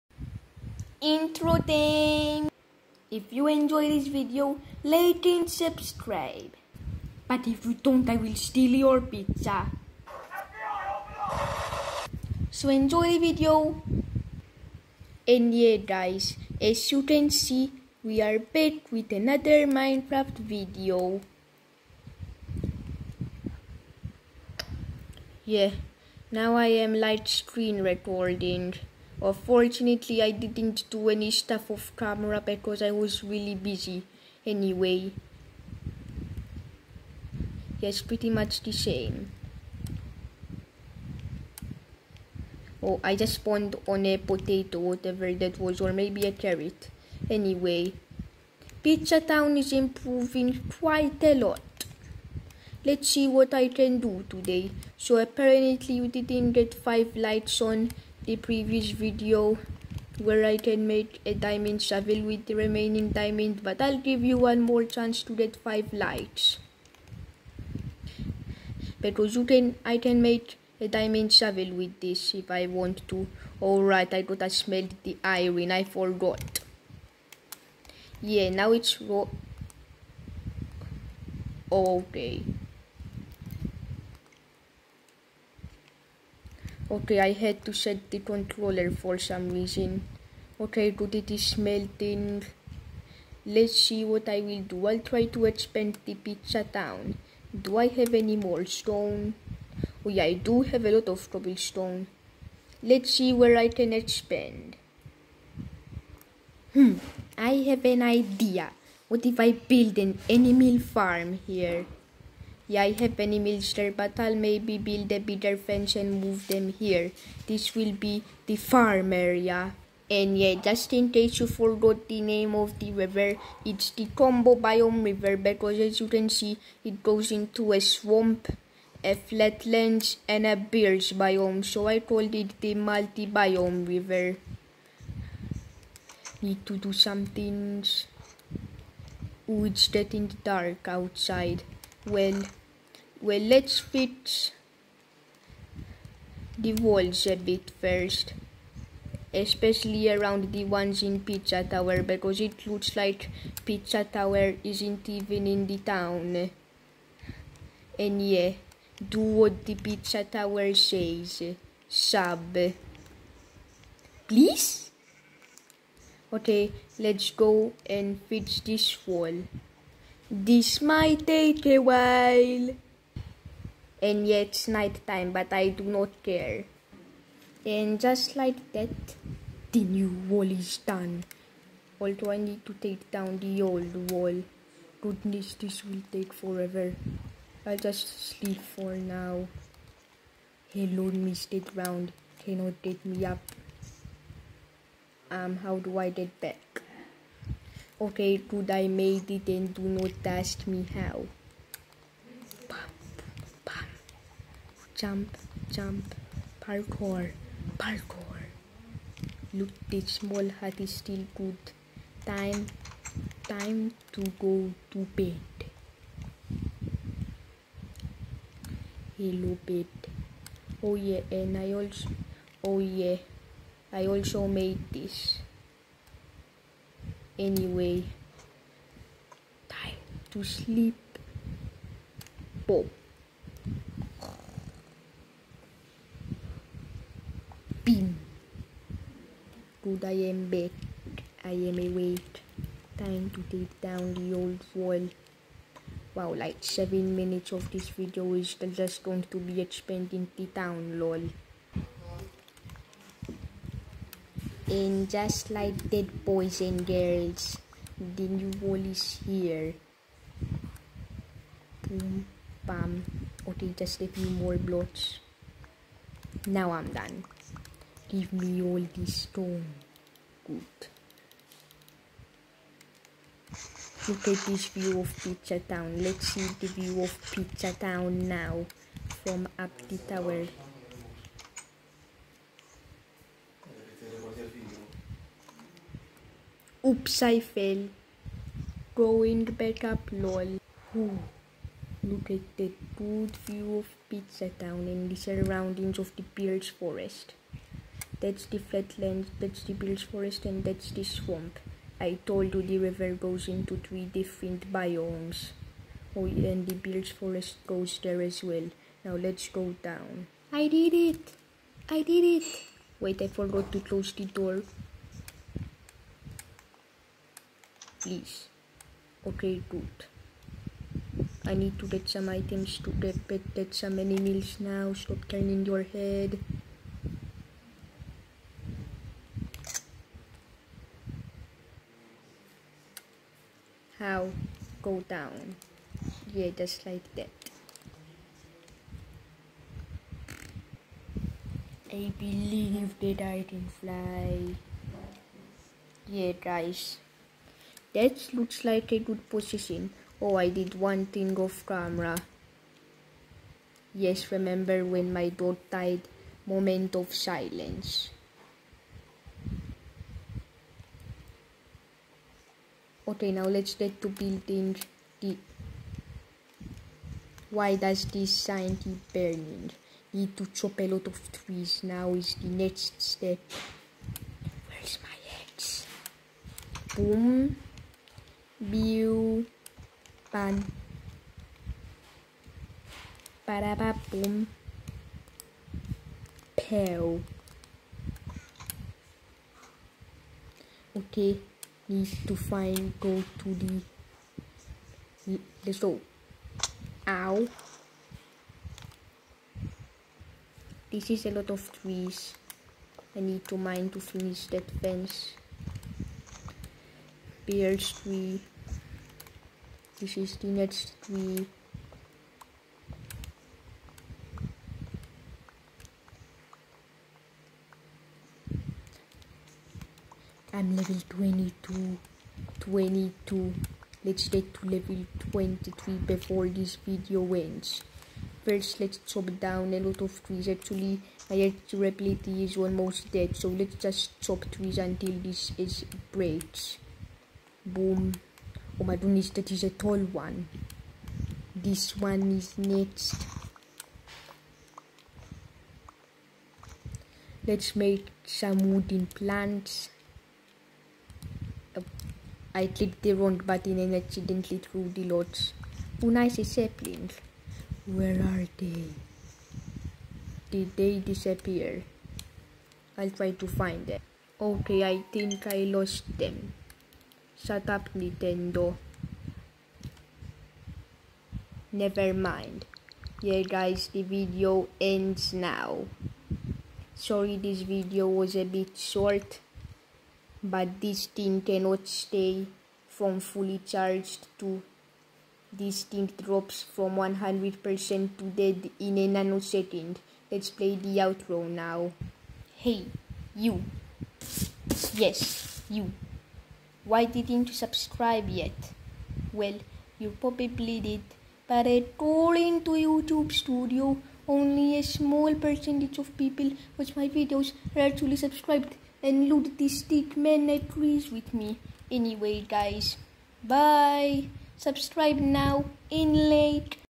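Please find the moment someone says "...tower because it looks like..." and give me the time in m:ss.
2:31.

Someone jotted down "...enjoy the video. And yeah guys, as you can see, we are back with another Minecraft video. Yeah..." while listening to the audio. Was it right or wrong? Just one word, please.
right.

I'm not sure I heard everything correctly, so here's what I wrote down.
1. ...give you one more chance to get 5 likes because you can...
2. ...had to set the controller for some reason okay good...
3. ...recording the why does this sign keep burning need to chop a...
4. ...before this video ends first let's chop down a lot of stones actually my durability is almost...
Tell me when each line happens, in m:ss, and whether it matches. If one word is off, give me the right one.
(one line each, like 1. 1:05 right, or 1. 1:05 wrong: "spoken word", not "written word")
1. 1:03 right
2. 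1:27 right
3. 6:04 wrong: "building", not "recording"
4. 7:06 wrong: "trees", not "stones".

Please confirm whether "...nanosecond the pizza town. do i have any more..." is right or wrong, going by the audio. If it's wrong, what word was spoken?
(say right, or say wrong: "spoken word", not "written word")
wrong: "expand", not "nanosecond".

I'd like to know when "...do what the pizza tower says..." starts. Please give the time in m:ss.
2:39.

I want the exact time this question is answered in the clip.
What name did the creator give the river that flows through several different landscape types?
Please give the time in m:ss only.
2:12.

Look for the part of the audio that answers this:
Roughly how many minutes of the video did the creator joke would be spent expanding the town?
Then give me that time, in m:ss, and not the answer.
4:06.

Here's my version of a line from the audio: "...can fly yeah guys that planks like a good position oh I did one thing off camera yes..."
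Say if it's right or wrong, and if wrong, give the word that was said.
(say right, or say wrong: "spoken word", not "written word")
wrong: "looks", not "planks".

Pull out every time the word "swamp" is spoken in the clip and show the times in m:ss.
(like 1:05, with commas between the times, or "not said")
2:07, 5:01.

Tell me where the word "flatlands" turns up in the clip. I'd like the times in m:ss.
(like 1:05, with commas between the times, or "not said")
2:09, 4:58.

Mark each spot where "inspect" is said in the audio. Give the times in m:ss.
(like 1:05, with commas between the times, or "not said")
not said.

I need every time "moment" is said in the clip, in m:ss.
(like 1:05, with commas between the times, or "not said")
5:56.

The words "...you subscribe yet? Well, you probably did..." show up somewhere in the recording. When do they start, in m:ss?
8:17.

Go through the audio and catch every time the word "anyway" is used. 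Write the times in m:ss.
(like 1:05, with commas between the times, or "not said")
0:34, 0:47, 3:47, 8:31.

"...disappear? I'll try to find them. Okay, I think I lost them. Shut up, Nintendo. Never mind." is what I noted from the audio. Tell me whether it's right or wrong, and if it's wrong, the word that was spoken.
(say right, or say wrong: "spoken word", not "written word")
right.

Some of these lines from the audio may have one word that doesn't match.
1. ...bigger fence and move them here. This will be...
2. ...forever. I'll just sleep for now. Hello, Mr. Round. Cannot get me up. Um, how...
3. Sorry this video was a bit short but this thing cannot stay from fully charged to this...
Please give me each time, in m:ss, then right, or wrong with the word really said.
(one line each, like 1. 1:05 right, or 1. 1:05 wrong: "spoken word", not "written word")
1. 1:55 right
2. 3:06 right
3. 7:56 right.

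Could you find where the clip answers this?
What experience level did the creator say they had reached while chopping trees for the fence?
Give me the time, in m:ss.
7:00.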